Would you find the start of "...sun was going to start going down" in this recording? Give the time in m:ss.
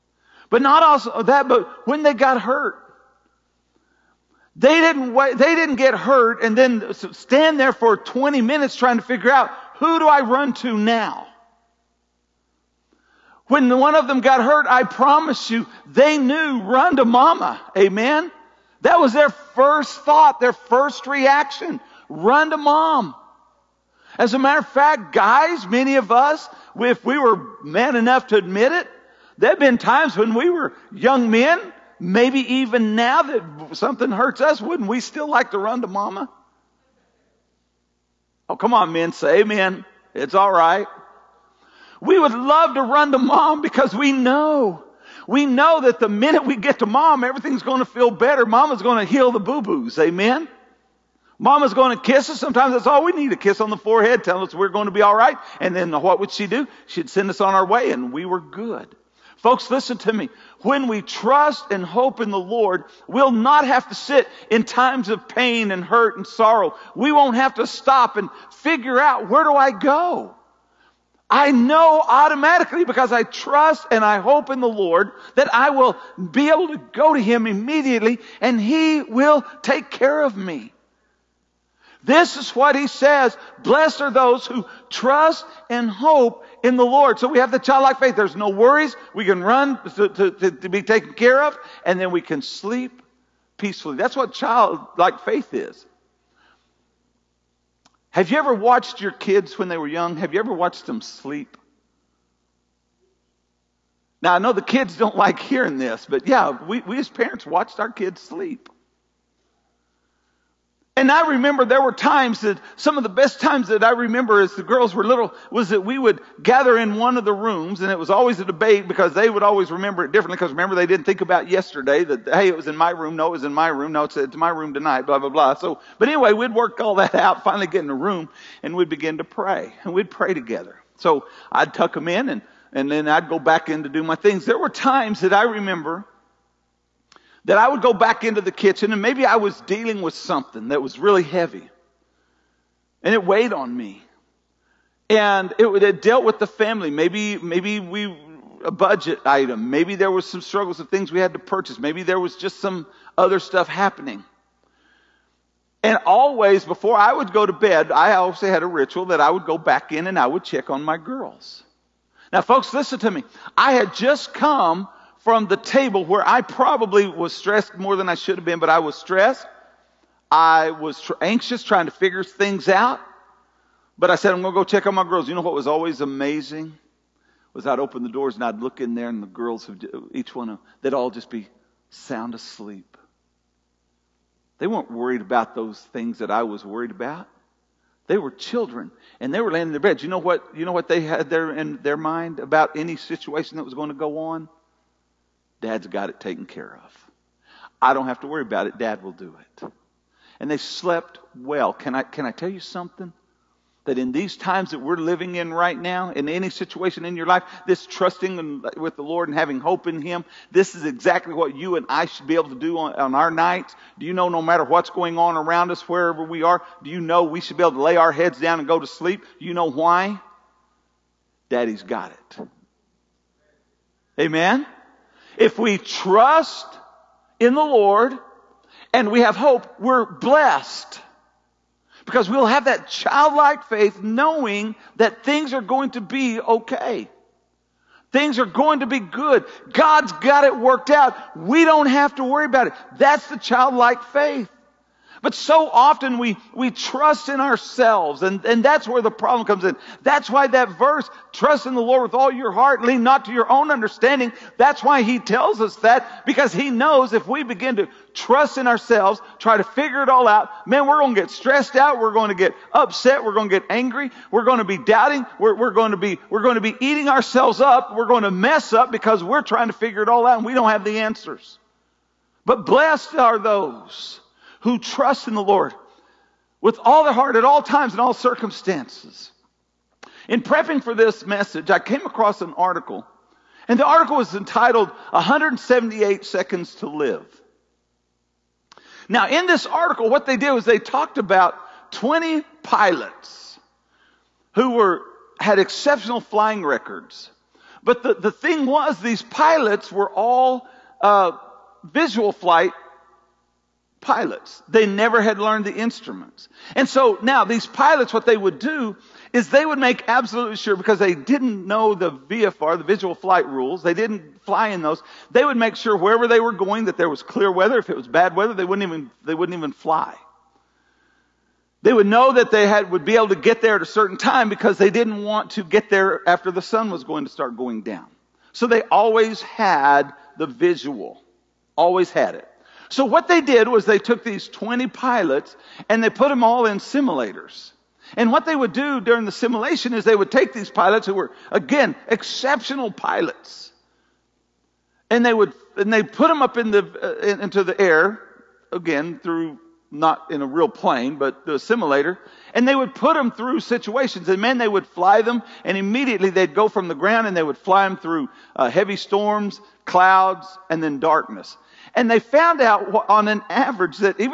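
5:26.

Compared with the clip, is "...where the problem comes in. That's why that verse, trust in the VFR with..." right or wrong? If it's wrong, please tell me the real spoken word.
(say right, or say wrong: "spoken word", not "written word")
wrong: "Lord", not "VFR".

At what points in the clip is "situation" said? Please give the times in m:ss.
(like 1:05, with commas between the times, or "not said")
3:12, 3:26, 5:53.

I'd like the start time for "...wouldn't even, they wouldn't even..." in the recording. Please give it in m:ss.
5:18.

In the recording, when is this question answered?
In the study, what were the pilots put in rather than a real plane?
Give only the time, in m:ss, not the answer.
5:36.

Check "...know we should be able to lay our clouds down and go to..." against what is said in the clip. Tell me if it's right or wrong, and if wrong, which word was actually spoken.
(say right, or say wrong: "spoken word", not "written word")
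wrong: "heads", not "clouds".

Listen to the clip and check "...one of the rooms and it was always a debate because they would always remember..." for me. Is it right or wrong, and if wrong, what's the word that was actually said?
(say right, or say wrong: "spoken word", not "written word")
right.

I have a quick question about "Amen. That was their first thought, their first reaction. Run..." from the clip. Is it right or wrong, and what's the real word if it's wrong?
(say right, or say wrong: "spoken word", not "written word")
right.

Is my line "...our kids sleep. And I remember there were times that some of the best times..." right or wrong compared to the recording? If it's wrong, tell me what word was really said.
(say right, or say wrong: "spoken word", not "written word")
right.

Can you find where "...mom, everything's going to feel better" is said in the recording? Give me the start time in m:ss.
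0:46.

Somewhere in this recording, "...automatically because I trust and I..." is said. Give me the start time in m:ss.
1:12.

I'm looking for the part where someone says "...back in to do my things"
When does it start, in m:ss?
2:13.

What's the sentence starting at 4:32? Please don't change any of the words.
But blessed are those who trust in the Lord with all their heart at all times and all circumstances.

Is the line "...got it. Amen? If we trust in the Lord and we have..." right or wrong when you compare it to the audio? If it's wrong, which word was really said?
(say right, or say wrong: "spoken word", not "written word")
right.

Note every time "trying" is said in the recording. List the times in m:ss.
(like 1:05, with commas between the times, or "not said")
0:08, 2:51, 4:29.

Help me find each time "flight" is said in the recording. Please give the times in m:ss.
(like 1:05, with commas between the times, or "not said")
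5:02, 5:13.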